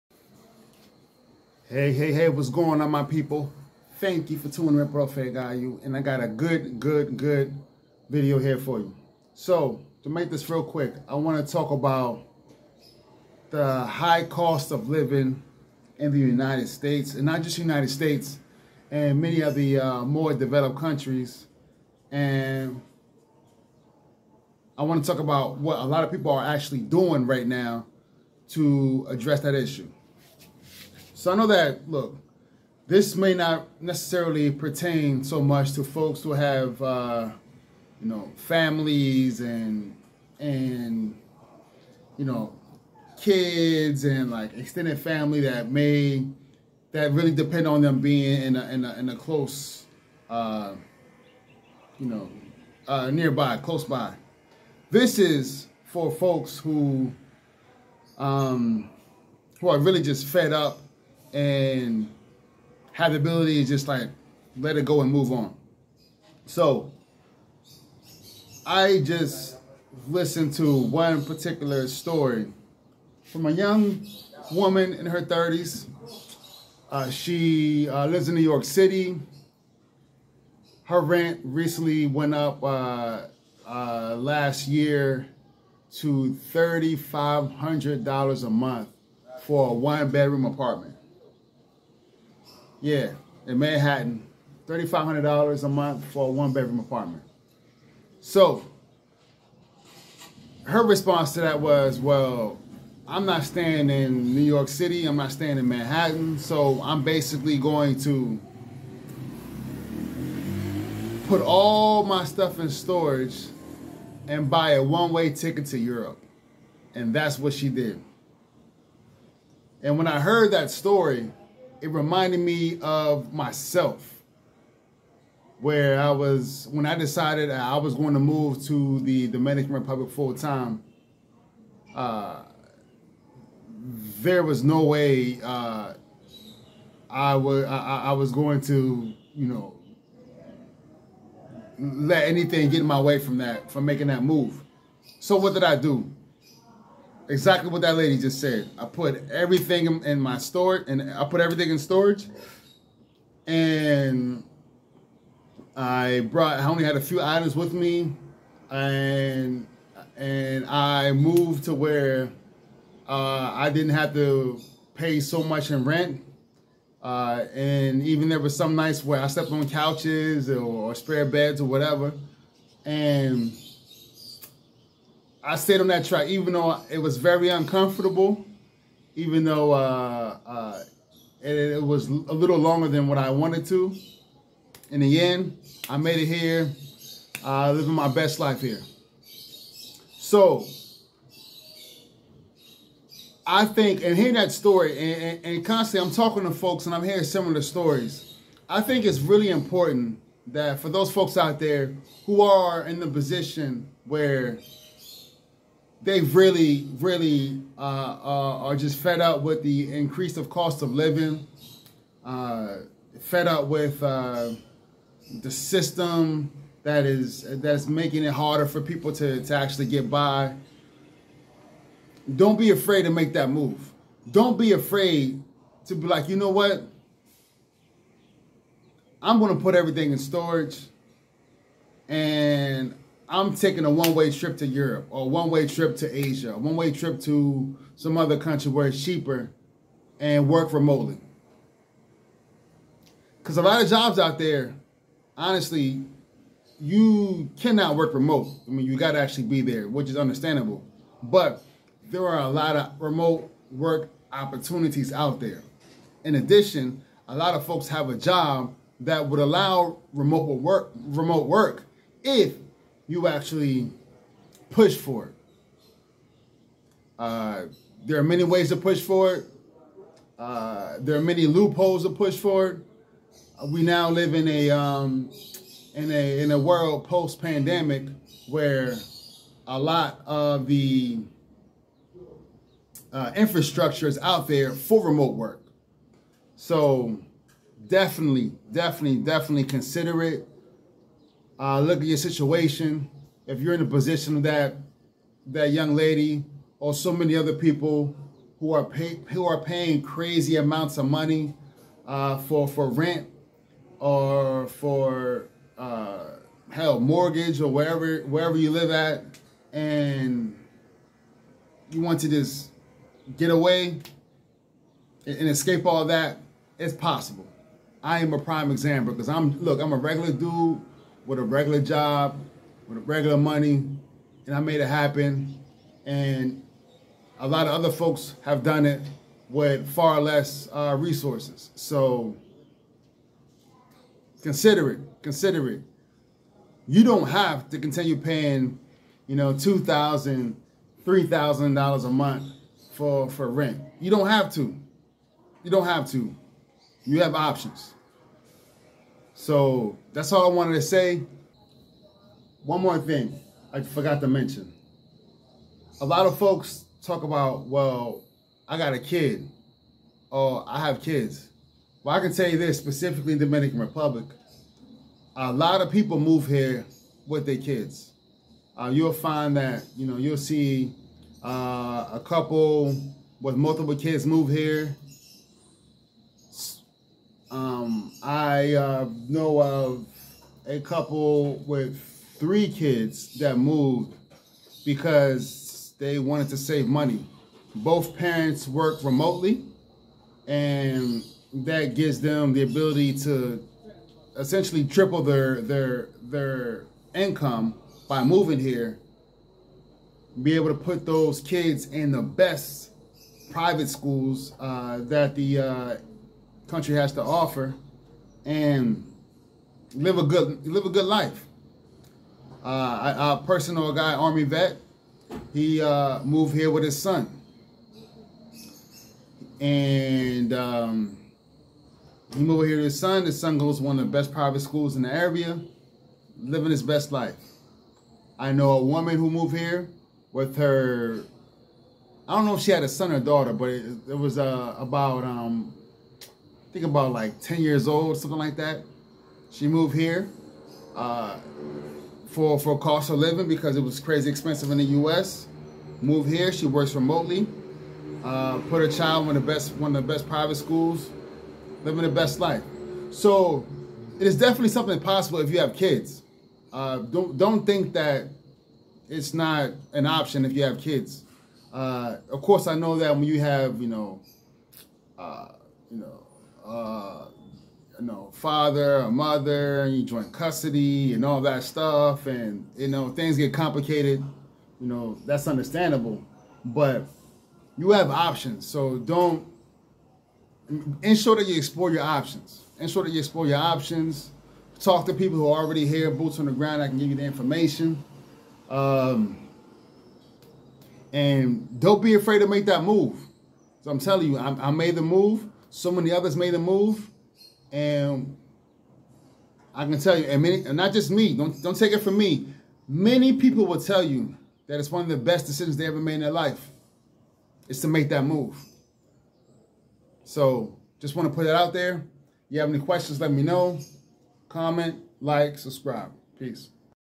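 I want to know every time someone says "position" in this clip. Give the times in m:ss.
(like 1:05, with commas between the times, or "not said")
3:23, 4:53.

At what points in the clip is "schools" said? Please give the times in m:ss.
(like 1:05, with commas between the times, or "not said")
6:43, 7:04, 7:30.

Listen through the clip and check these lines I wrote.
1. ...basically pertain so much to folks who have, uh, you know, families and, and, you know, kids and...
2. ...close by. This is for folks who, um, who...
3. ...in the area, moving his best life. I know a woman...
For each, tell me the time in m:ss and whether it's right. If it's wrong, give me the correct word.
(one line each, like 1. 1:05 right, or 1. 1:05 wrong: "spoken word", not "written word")
1. 0:33 wrong: "necessarily", not "basically"
2. 0:53 right
3. 7:04 wrong: "living", not "moving".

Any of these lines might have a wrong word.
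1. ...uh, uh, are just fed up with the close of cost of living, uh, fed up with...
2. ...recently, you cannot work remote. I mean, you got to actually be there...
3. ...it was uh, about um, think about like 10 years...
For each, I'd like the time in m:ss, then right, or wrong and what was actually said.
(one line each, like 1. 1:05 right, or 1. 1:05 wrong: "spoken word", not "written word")
1. 3:27 wrong: "increase", not "close"
2. 4:05 wrong: "honestly", not "recently"
3. 7:14 right.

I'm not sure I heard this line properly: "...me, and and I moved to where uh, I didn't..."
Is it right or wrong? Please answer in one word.
right.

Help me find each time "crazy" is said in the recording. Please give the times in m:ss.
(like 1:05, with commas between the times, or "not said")
5:00, 7:23.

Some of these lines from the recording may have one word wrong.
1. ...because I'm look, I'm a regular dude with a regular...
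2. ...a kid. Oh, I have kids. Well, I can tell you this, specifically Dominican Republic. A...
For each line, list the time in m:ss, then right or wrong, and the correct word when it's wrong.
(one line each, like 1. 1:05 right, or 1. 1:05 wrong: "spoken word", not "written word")
1. 5:19 right
2. 5:58 right.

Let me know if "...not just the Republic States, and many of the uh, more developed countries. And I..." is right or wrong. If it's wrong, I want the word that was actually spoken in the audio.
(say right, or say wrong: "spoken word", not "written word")
wrong: "United", not "Republic".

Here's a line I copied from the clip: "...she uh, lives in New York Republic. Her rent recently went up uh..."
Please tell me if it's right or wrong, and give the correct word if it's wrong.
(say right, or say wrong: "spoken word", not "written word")
wrong: "City", not "Republic".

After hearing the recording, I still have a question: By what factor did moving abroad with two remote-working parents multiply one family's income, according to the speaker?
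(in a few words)
Triple.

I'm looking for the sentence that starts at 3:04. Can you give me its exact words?
In the end, I made it here, uh, living my best life here.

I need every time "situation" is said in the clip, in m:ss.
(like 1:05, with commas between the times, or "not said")
4:52.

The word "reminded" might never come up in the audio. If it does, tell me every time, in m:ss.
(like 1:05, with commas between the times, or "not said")
2:01.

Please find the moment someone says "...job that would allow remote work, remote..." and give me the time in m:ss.
4:18.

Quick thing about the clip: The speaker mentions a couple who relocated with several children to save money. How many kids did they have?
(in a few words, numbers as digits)
3.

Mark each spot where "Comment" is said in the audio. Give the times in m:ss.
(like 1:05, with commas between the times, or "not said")
8:34.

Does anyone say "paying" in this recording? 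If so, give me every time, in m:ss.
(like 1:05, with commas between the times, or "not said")
4:59, 5:38.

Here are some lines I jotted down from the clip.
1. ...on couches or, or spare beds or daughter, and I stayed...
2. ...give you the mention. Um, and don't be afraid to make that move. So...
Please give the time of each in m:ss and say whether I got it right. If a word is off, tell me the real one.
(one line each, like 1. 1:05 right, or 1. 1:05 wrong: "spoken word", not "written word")
1. 2:49 wrong: "whatever", not "daughter"
2. 8:06 wrong: "information", not "mention".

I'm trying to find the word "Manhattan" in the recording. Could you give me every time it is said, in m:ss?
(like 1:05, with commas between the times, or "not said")
1:33, 1:45.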